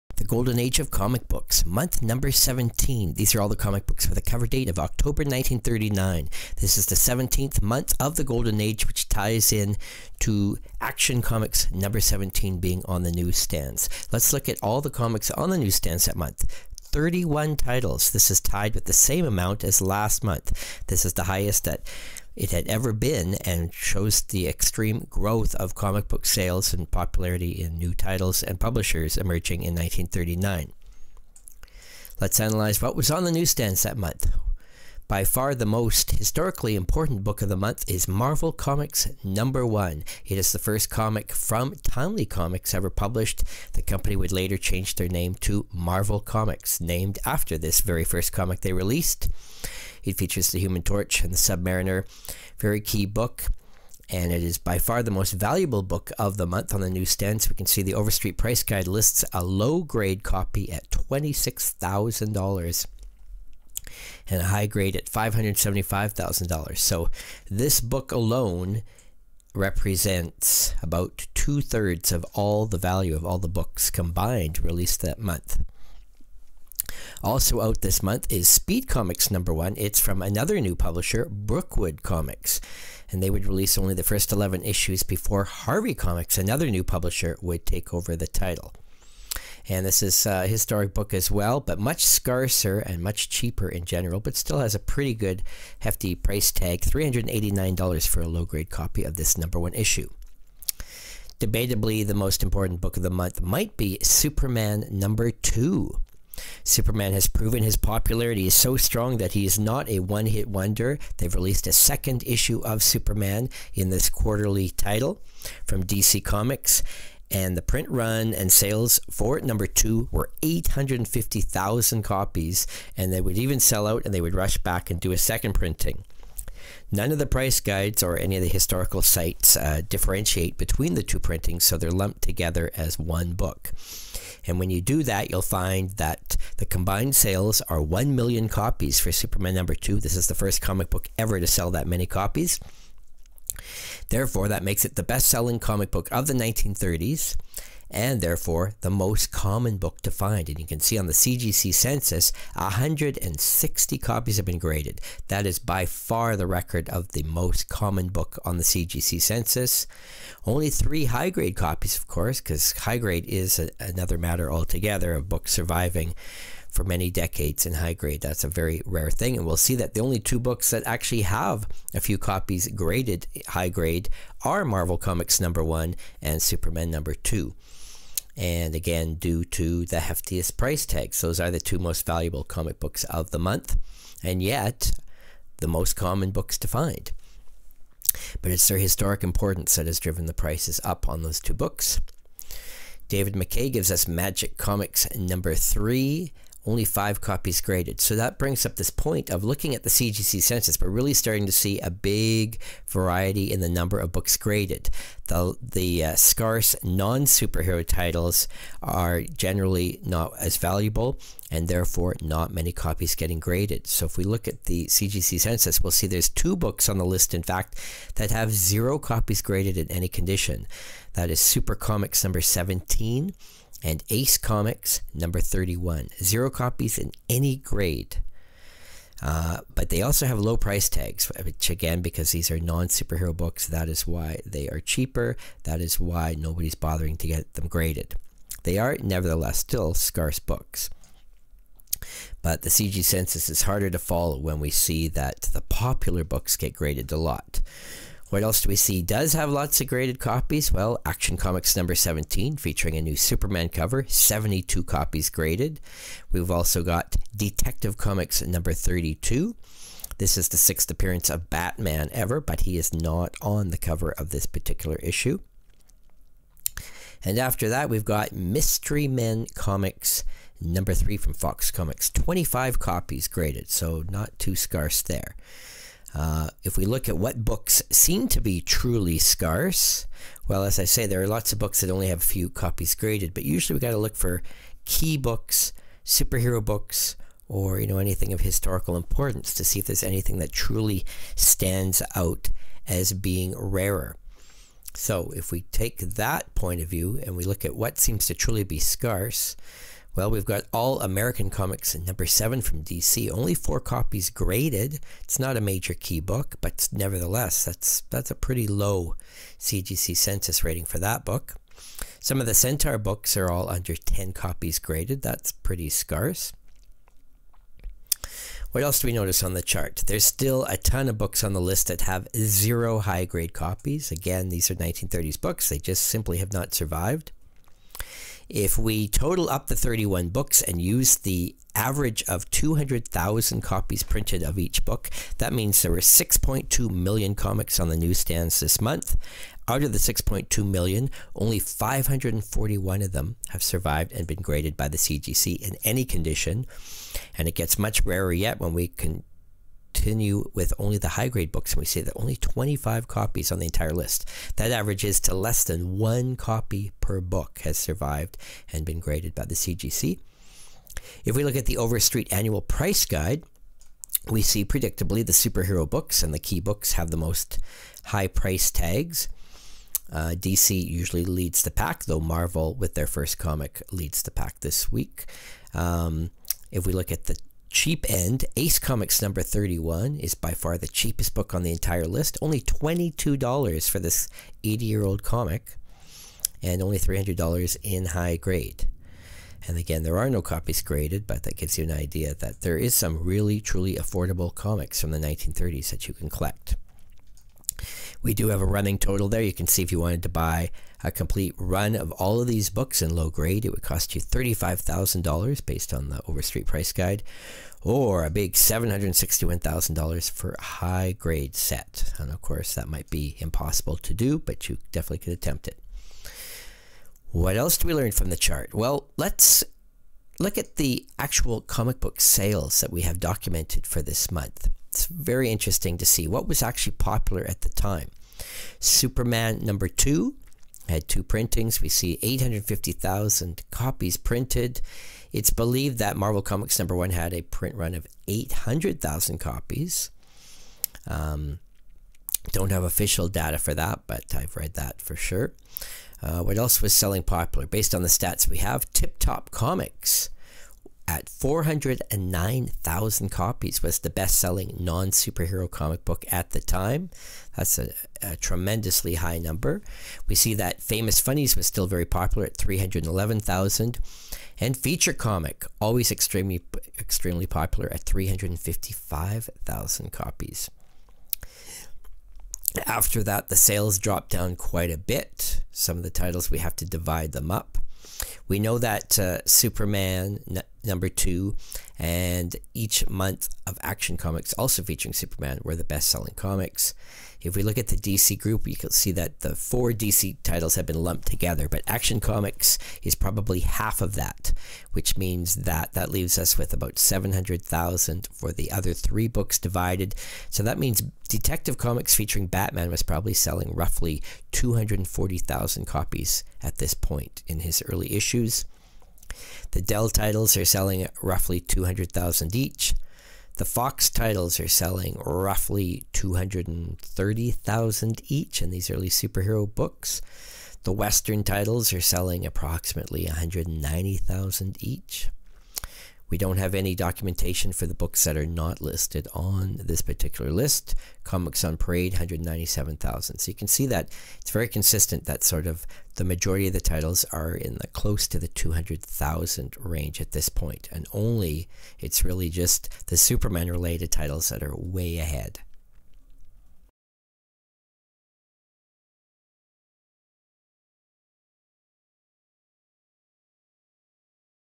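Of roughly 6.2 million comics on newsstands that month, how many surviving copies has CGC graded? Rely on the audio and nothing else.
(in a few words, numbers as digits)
541.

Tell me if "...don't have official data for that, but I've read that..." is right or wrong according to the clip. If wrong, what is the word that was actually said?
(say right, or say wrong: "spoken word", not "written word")
right.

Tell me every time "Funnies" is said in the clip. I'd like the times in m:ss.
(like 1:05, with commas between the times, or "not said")
7:41.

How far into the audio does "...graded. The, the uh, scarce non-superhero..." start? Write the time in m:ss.
3:24.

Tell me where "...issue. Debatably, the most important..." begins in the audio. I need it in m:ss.
1:39.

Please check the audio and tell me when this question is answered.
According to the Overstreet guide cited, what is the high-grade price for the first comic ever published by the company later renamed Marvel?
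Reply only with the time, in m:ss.
1:05.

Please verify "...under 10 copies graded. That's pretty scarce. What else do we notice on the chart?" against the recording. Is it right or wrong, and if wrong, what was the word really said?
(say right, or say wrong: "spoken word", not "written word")
right.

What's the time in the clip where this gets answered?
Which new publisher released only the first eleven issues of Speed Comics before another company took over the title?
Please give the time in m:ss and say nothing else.
1:21.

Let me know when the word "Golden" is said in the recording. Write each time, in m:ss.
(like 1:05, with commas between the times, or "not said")
0:00, 0:08.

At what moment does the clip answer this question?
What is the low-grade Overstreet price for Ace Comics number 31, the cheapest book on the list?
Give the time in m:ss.
6:22.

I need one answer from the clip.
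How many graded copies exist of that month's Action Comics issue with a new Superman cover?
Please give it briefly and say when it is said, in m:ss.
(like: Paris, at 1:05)
72, at 4:14.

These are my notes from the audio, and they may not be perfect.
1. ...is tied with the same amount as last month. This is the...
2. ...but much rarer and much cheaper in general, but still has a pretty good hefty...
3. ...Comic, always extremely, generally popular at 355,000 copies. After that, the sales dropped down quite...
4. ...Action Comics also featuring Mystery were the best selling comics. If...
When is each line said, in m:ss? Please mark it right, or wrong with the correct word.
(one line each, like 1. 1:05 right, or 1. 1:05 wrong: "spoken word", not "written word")
1. 0:18 right
2. 1:31 wrong: "scarcer", not "rarer"
3. 7:45 wrong: "extremely", not "generally"
4. 8:03 wrong: "Superman", not "Mystery".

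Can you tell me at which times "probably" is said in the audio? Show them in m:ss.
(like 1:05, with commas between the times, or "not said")
8:13, 8:23.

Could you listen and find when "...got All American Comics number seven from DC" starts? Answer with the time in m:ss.
5:00.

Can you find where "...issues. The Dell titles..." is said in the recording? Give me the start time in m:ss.
8:28.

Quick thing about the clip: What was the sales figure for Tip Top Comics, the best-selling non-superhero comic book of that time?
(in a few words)
409,000.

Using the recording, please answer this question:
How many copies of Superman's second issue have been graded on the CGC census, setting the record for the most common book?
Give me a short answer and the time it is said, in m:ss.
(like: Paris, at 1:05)
160, at 2:32.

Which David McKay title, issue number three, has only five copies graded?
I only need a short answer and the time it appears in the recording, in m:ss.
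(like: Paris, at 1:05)
Magic Comics, at 3:14.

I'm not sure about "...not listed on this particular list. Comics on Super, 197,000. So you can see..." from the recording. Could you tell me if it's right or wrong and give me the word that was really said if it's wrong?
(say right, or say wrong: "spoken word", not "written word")
wrong: "Parade", not "Super".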